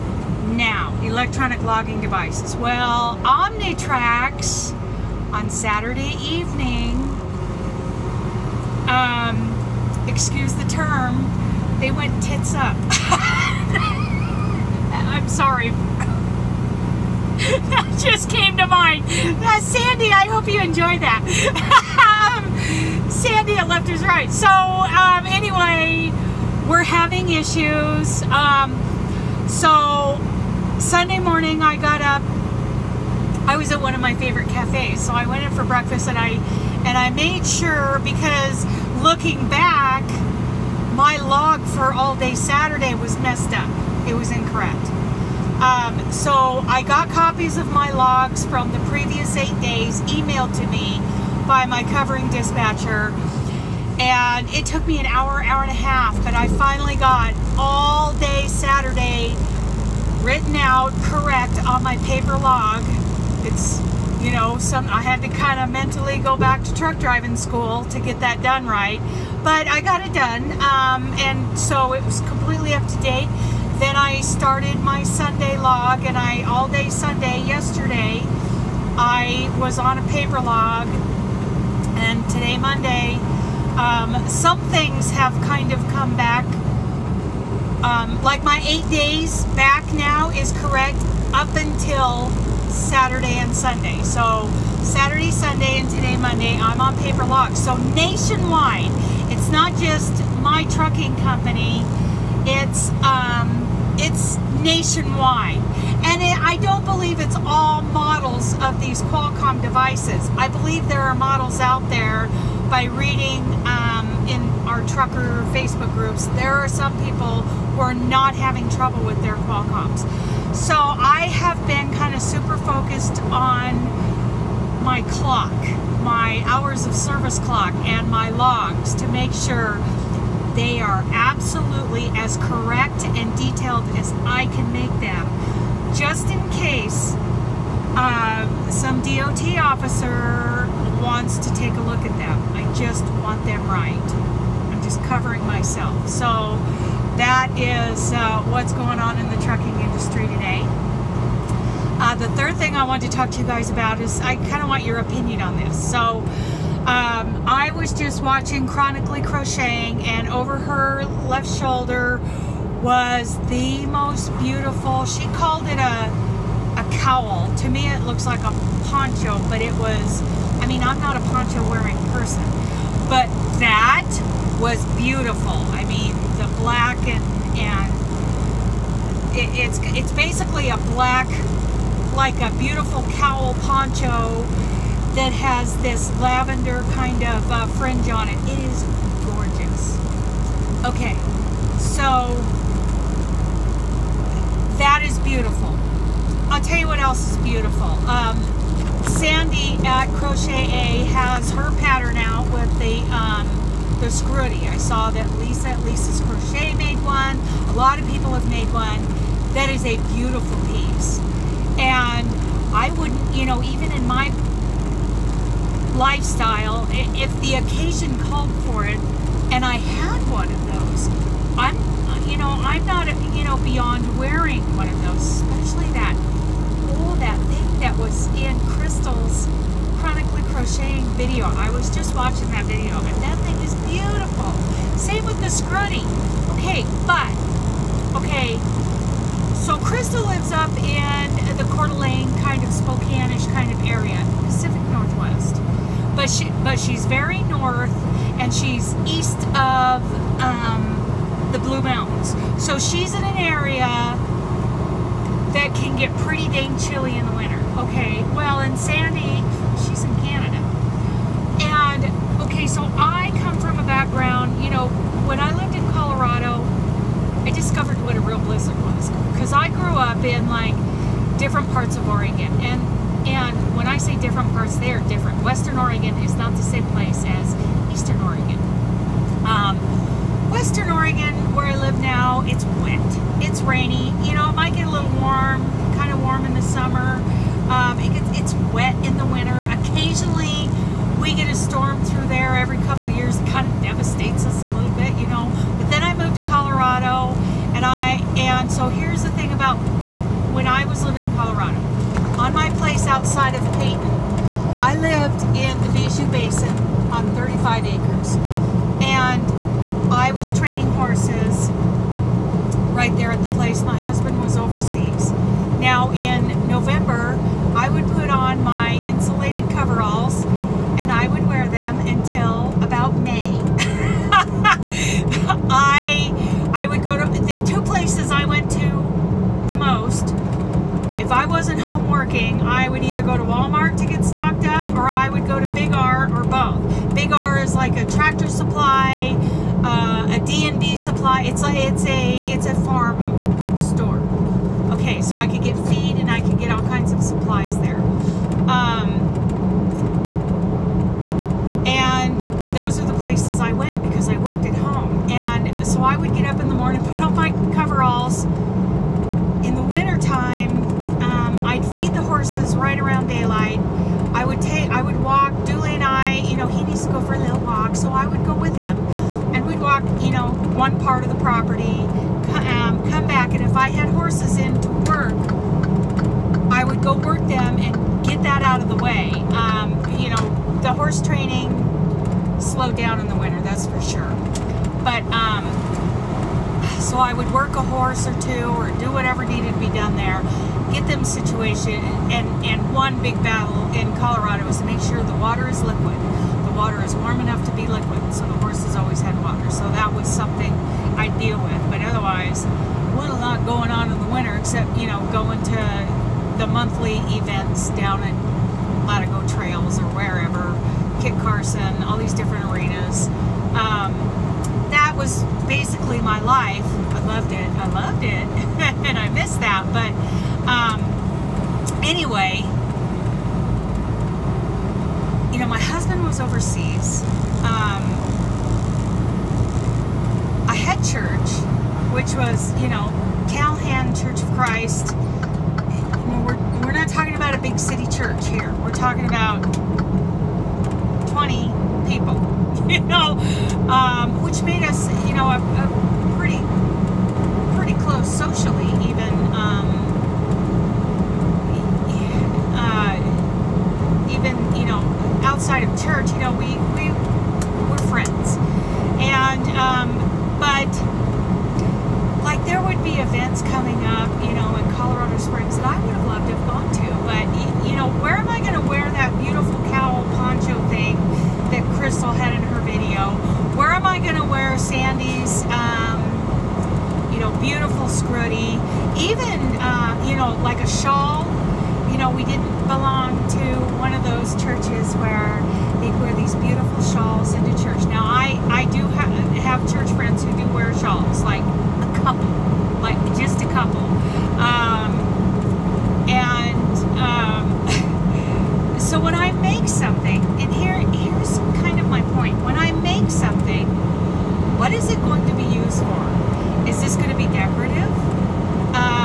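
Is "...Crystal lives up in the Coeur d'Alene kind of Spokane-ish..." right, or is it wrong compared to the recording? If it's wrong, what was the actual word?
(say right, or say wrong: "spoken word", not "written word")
right.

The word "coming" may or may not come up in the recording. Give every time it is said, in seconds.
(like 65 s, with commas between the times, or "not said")
463 s.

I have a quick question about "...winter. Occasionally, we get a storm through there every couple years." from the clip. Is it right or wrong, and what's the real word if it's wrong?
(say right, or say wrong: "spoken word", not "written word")
right.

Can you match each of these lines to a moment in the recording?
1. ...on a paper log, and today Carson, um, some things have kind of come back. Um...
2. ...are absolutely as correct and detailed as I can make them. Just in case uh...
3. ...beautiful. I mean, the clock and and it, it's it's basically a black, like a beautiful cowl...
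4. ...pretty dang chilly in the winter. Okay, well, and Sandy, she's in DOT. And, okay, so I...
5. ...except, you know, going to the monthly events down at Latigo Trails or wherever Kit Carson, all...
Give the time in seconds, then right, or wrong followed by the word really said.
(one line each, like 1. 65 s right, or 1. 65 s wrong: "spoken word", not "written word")
1. 79 s wrong: "Monday", not "Carson"
2. 130 s right
3. 174 s wrong: "black", not "clock"
4. 256 s wrong: "Canada", not "DOT"
5. 404 s right.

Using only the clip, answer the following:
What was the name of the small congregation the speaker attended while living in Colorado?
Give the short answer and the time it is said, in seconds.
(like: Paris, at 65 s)
Calhan Church of Christ, at 433 s.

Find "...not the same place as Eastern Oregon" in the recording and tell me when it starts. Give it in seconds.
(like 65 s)
276 s.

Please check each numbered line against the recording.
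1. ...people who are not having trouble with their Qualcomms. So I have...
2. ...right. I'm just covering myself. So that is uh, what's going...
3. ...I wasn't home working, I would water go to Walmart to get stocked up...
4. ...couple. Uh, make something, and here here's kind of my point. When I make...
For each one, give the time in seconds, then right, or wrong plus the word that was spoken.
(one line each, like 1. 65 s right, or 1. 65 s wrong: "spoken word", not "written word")
1. 117 s right
2. 143 s right
3. 331 s wrong: "either", not "water"
4. 493 s right.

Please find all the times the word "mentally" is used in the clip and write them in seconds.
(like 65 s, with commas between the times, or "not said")
65 s.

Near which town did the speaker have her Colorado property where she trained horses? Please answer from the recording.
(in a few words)
Peyton.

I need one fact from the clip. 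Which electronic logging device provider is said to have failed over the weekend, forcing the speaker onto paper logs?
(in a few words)
Omnitracs.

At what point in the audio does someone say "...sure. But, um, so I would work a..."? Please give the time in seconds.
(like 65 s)
384 s.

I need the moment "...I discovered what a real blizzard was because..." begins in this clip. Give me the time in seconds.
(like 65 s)
267 s.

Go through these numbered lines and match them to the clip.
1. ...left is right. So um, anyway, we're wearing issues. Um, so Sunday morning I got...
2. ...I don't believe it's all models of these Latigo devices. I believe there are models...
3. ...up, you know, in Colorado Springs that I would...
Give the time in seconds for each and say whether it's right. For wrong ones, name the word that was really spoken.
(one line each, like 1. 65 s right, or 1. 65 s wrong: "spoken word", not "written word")
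1. 23 s wrong: "having", not "wearing"
2. 106 s wrong: "Qualcomm", not "Latigo"
3. 464 s right.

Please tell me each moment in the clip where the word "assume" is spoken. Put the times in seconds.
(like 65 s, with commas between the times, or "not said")
not said.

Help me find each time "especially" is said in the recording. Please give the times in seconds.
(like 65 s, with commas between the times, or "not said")
225 s.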